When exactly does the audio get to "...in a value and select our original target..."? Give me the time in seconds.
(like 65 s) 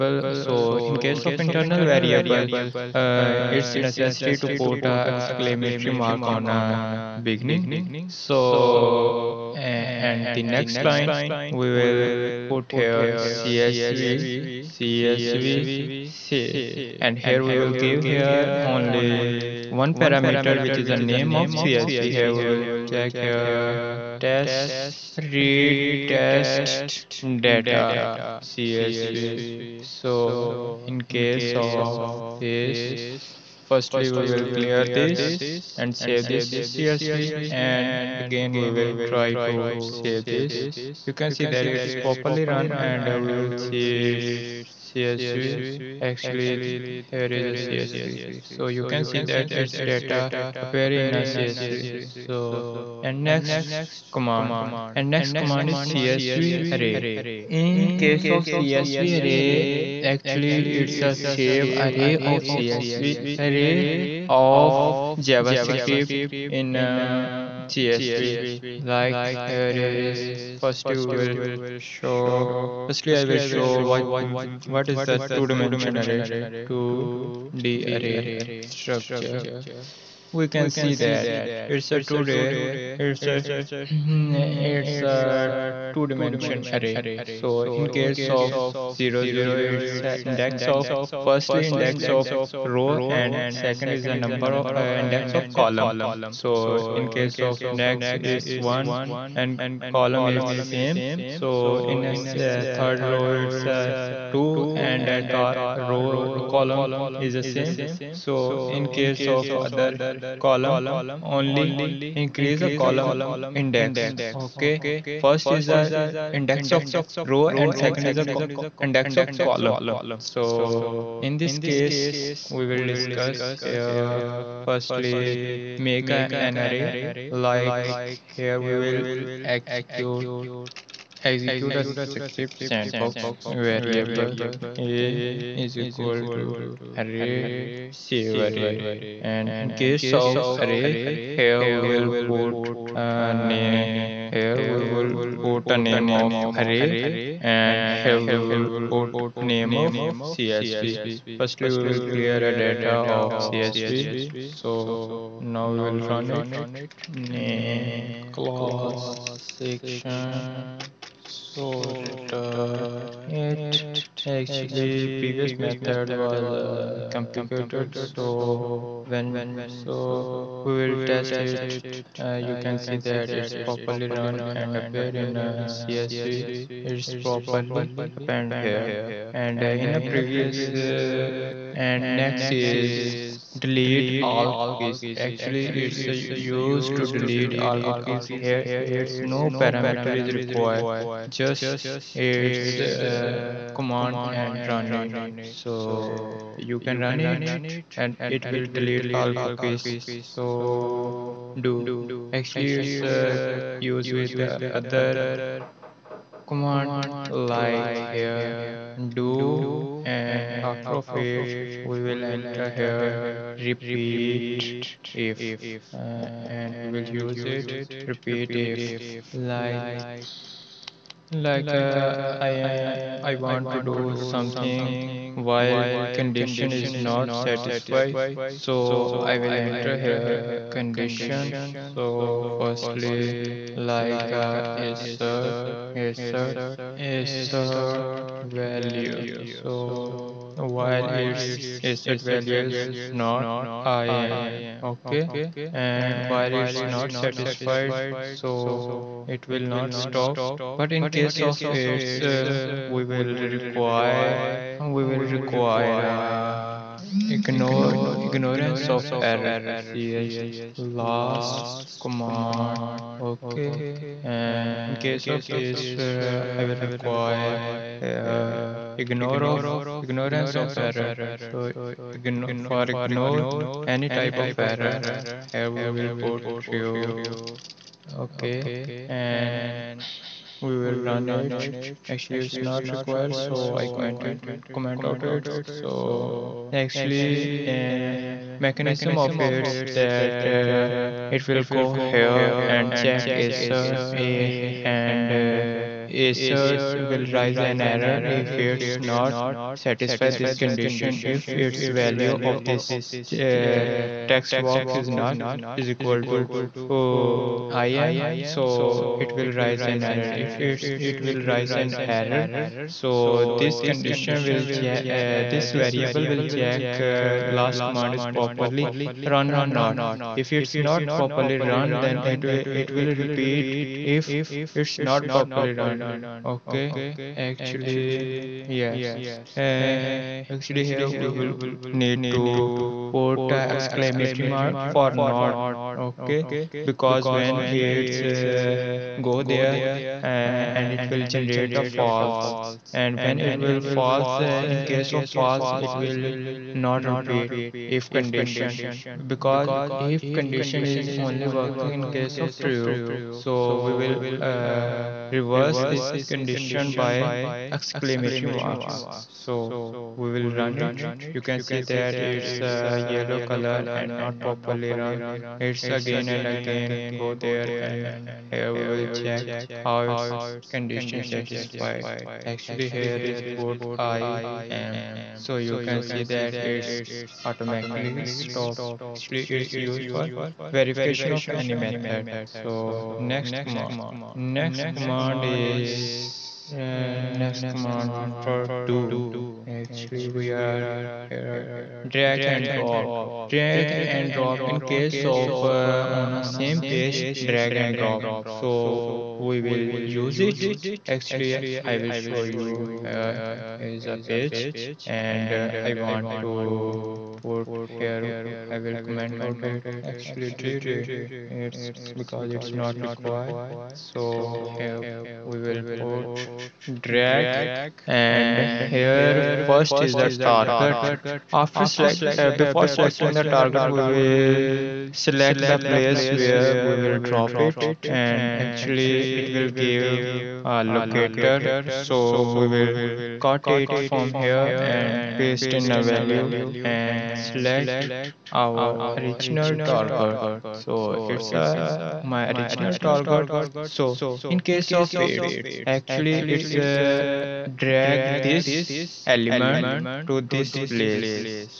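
435 s.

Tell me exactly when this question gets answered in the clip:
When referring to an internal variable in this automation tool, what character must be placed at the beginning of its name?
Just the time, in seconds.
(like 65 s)
5 s.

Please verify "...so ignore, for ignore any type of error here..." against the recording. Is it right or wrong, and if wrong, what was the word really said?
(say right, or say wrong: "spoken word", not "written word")
right.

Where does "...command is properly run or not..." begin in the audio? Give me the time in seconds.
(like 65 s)
317 s.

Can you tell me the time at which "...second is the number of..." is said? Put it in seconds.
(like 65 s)
93 s.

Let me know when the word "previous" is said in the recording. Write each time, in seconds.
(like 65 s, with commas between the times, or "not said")
165 s, 179 s.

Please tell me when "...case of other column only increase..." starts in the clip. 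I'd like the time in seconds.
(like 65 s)
108 s.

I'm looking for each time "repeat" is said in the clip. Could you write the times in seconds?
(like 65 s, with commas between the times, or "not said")
213 s, 218 s, 323 s, 347 s.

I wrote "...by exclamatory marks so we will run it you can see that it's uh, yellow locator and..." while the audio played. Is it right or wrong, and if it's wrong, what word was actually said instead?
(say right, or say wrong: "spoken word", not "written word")
wrong: "color", not "locator".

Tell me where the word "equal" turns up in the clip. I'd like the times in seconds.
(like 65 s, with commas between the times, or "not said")
135 s, 305 s.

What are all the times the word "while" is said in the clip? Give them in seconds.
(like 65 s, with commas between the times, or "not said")
225 s, 240 s, 246 s.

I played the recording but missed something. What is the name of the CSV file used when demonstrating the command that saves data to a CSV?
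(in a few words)
test data CSV.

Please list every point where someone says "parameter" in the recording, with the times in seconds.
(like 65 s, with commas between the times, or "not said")
19 s, 189 s.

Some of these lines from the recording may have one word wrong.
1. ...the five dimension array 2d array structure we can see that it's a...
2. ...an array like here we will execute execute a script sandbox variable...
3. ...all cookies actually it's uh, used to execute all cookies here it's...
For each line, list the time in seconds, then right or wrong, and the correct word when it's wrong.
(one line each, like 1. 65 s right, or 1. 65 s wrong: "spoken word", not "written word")
1. 75 s wrong: "two", not "five"
2. 126 s right
3. 184 s wrong: "delete", not "execute".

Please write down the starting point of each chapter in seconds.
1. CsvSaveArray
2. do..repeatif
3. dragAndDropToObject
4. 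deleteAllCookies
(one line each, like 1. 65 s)
1. 53 s
2. 201 s
3. 392 s
4. 182 s.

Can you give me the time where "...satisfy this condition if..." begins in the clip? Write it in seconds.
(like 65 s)
299 s.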